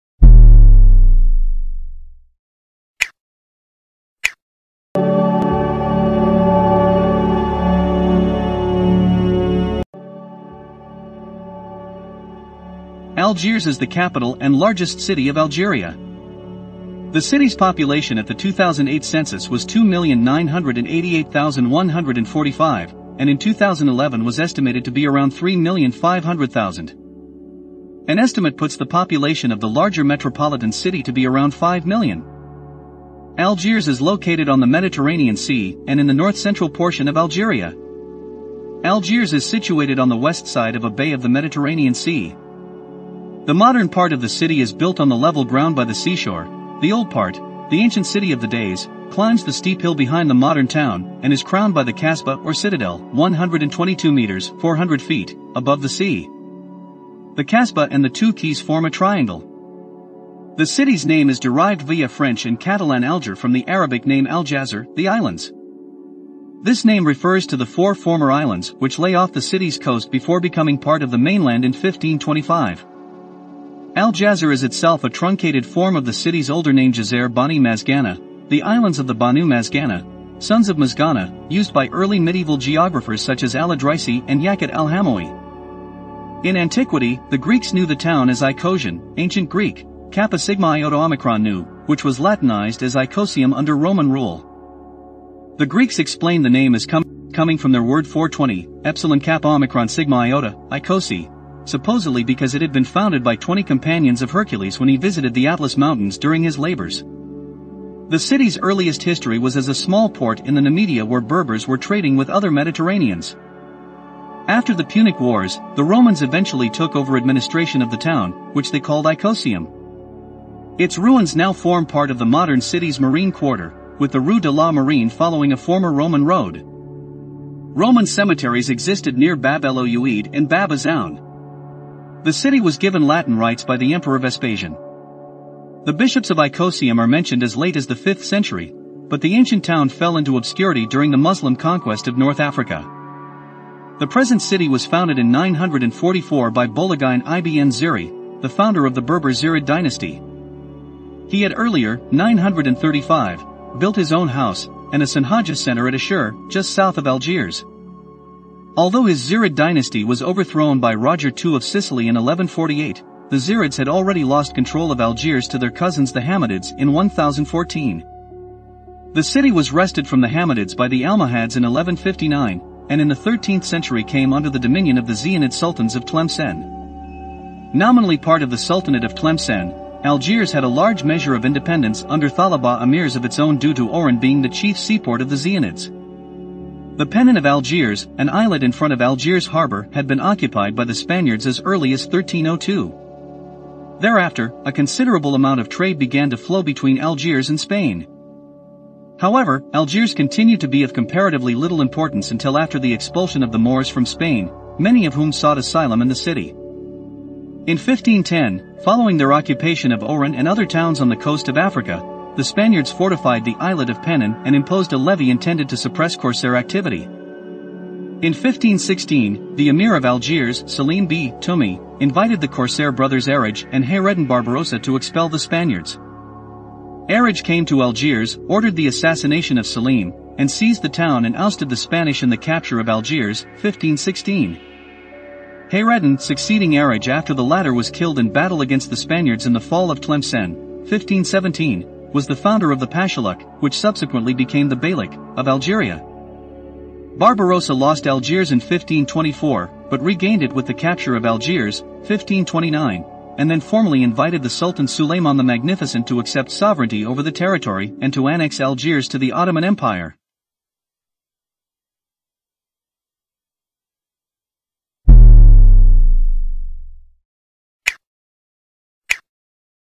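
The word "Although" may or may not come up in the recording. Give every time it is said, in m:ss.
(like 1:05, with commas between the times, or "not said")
2:38.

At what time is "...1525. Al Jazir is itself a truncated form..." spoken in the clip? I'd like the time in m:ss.
1:11.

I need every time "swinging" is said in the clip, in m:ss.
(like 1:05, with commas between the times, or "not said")
not said.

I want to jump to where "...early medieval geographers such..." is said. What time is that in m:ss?
1:21.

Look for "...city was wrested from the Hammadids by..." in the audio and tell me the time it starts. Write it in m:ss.
2:49.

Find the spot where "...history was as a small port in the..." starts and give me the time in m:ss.
1:49.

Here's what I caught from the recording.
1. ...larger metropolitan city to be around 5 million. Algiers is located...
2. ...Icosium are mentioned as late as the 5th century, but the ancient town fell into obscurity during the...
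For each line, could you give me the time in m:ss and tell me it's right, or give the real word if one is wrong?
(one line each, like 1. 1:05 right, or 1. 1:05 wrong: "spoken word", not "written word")
1. 0:29 right
2. 2:16 right.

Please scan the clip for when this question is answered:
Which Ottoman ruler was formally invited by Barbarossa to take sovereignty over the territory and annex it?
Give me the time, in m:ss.
4:14.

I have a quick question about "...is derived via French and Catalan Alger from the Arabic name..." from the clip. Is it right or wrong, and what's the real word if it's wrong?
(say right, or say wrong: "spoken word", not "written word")
right.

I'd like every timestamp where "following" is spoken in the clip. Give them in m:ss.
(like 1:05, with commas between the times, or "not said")
2:05, 3:28.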